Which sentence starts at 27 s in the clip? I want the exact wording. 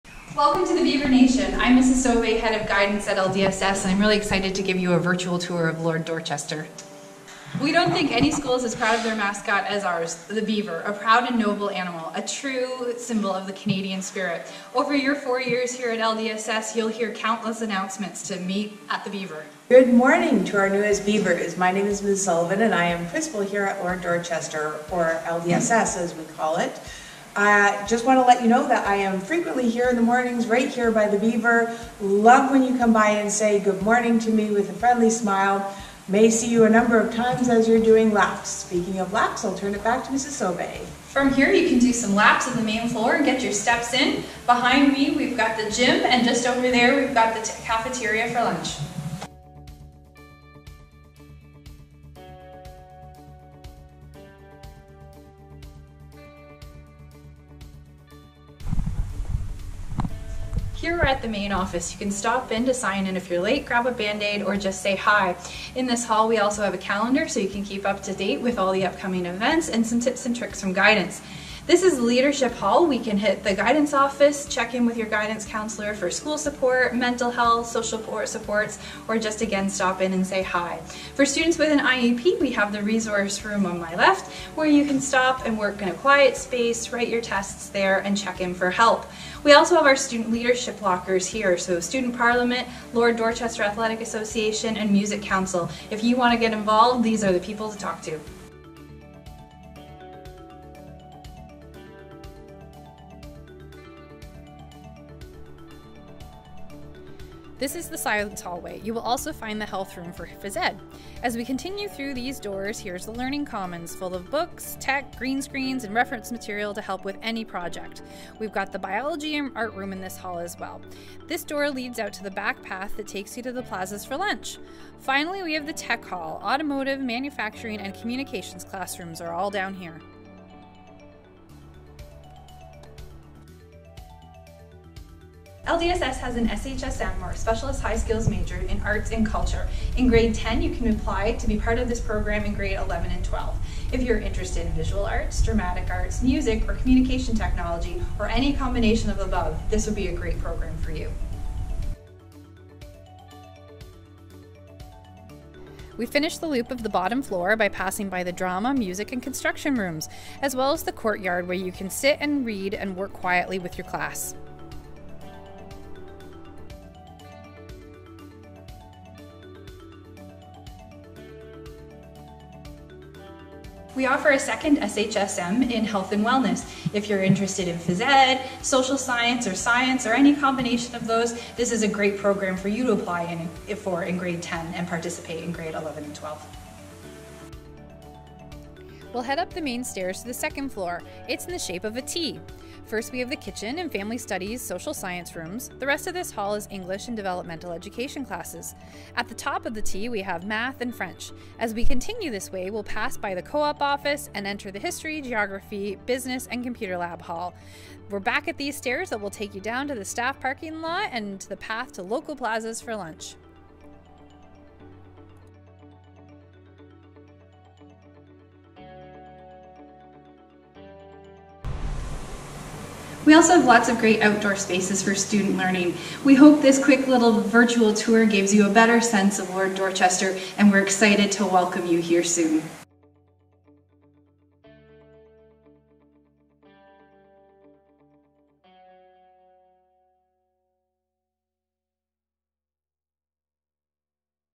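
I just want to let you know that I am frequently here in the mornings, right here by the Beaver.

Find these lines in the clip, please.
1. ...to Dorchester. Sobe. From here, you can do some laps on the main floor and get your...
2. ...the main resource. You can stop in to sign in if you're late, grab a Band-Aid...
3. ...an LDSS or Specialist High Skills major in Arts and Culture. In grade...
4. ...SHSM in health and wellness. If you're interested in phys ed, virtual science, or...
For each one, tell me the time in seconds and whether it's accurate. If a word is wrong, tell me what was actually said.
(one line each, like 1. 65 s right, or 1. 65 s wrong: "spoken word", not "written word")
1. 40 s wrong: "Mrs", not "Dorchester"
2. 61 s wrong: "office", not "resource"
3. 136 s wrong: "SHSM", not "LDSS"
4. 174 s wrong: "social", not "virtual".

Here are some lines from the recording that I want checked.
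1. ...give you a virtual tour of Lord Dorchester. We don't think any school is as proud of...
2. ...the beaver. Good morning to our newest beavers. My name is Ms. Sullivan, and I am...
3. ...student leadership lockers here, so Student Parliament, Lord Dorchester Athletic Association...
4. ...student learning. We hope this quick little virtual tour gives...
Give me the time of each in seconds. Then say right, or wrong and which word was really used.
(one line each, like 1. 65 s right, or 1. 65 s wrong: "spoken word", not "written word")
1. 4 s right
2. 19 s right
3. 89 s right
4. 225 s right.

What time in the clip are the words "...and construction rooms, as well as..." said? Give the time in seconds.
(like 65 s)
159 s.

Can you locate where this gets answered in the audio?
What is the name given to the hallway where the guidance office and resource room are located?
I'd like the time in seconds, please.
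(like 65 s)
72 s.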